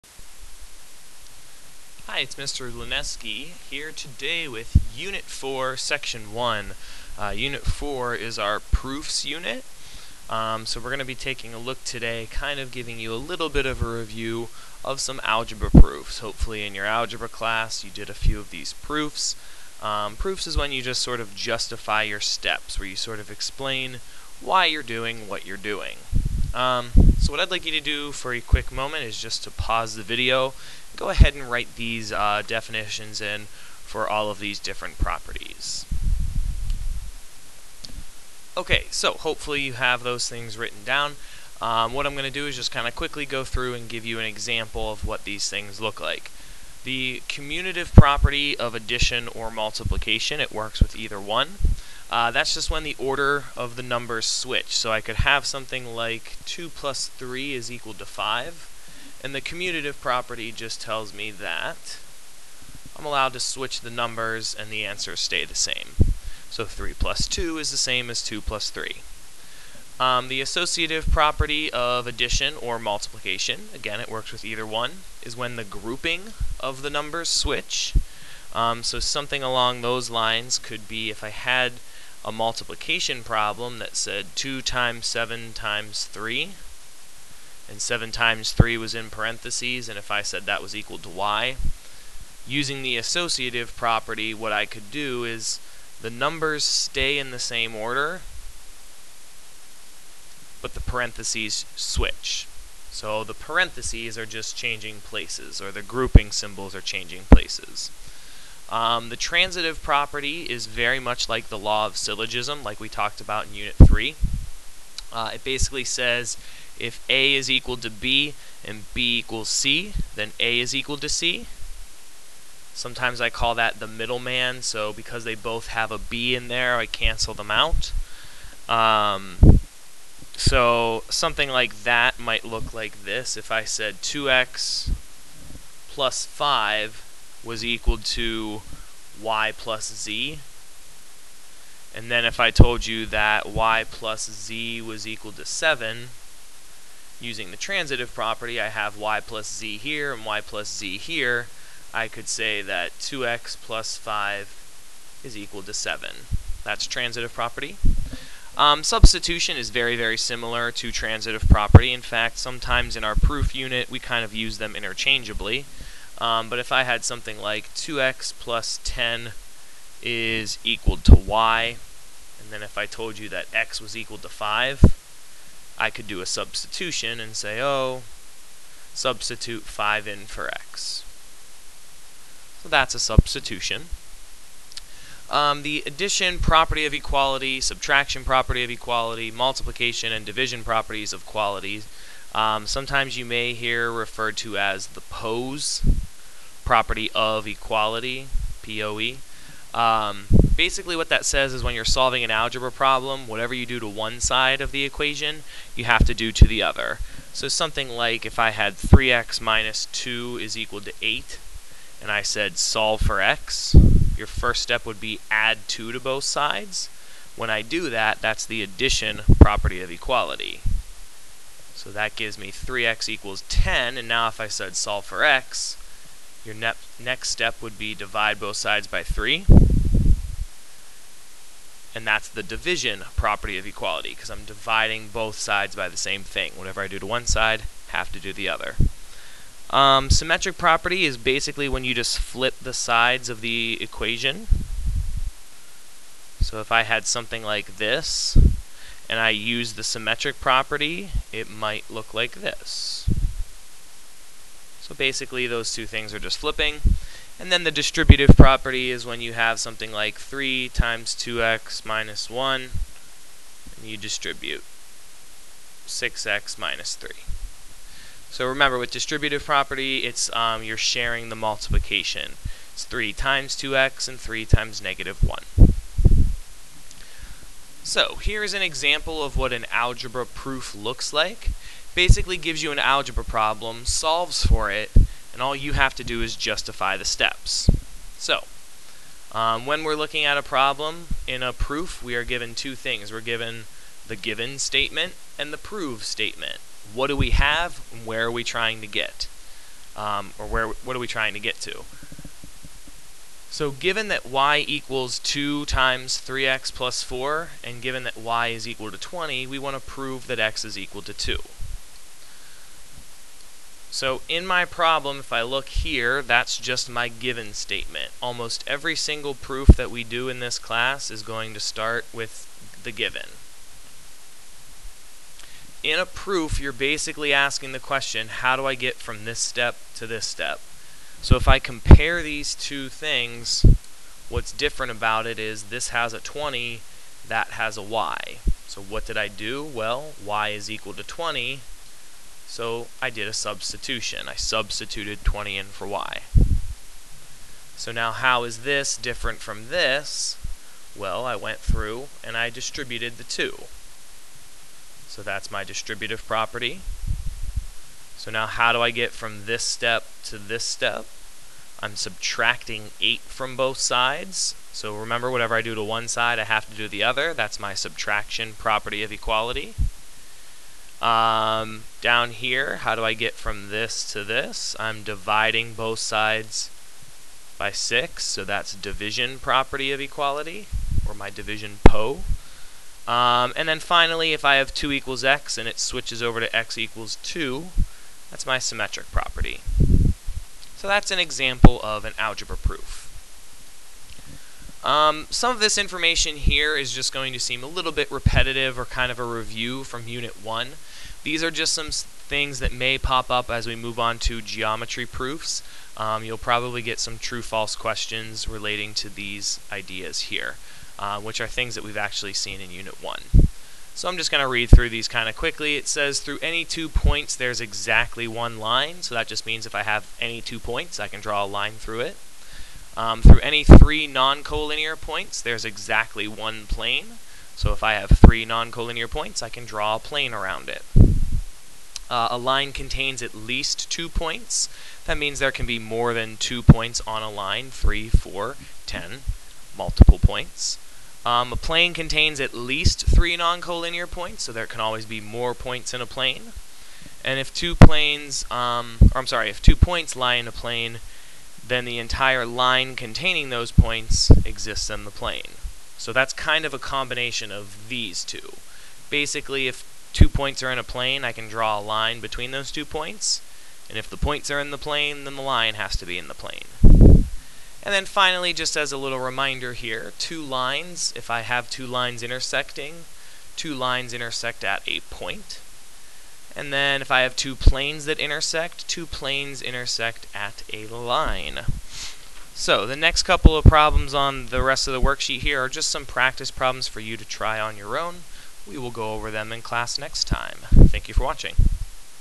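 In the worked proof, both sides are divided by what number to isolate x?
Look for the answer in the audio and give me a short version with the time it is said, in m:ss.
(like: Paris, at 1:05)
6, at 6:15.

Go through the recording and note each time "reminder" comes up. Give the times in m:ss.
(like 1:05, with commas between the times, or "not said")
7:49.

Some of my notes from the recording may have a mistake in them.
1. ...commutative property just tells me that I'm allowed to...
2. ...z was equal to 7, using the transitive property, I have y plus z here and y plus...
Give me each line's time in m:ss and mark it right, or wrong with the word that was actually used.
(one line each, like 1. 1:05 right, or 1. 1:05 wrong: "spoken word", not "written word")
1. 0:59 right
2. 2:24 right.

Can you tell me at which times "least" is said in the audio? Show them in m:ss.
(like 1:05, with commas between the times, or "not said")
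7:13, 7:22.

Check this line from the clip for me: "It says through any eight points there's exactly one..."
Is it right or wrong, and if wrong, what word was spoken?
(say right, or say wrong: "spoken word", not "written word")
wrong: "two", not "eight".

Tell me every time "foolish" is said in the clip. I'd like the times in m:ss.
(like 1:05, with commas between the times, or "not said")
not said.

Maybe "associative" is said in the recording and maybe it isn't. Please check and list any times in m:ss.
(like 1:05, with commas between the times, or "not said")
1:10, 1:32.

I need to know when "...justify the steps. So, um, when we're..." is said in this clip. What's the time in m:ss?
4:46.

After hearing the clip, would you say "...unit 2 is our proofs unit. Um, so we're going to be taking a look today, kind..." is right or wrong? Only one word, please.
wrong.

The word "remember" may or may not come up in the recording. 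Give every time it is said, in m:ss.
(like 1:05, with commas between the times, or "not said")
4:28, 6:04.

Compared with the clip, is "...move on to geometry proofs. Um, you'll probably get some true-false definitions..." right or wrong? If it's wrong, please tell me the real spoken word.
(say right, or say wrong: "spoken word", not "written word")
wrong: "questions", not "definitions".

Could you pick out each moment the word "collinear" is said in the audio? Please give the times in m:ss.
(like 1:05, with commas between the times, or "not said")
7:04, 7:08, 7:23.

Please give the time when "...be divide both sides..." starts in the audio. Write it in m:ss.
3:47.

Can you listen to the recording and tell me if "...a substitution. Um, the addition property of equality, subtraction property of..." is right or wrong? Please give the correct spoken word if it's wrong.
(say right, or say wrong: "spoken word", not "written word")
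right.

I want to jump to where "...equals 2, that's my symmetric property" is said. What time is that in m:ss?
6:26.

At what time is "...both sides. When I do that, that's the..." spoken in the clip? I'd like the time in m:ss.
3:35.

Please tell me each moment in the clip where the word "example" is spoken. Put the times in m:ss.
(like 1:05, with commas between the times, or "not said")
0:44, 4:38, 6:31.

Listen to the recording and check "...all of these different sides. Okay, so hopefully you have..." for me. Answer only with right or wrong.
wrong.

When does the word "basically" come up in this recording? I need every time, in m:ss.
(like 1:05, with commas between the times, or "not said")
1:55, 3:20, 4:01, 4:14, 4:41, 5:26, 7:39.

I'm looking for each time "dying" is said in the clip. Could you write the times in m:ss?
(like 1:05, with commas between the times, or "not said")
not said.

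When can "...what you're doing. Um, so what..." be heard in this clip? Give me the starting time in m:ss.
0:25.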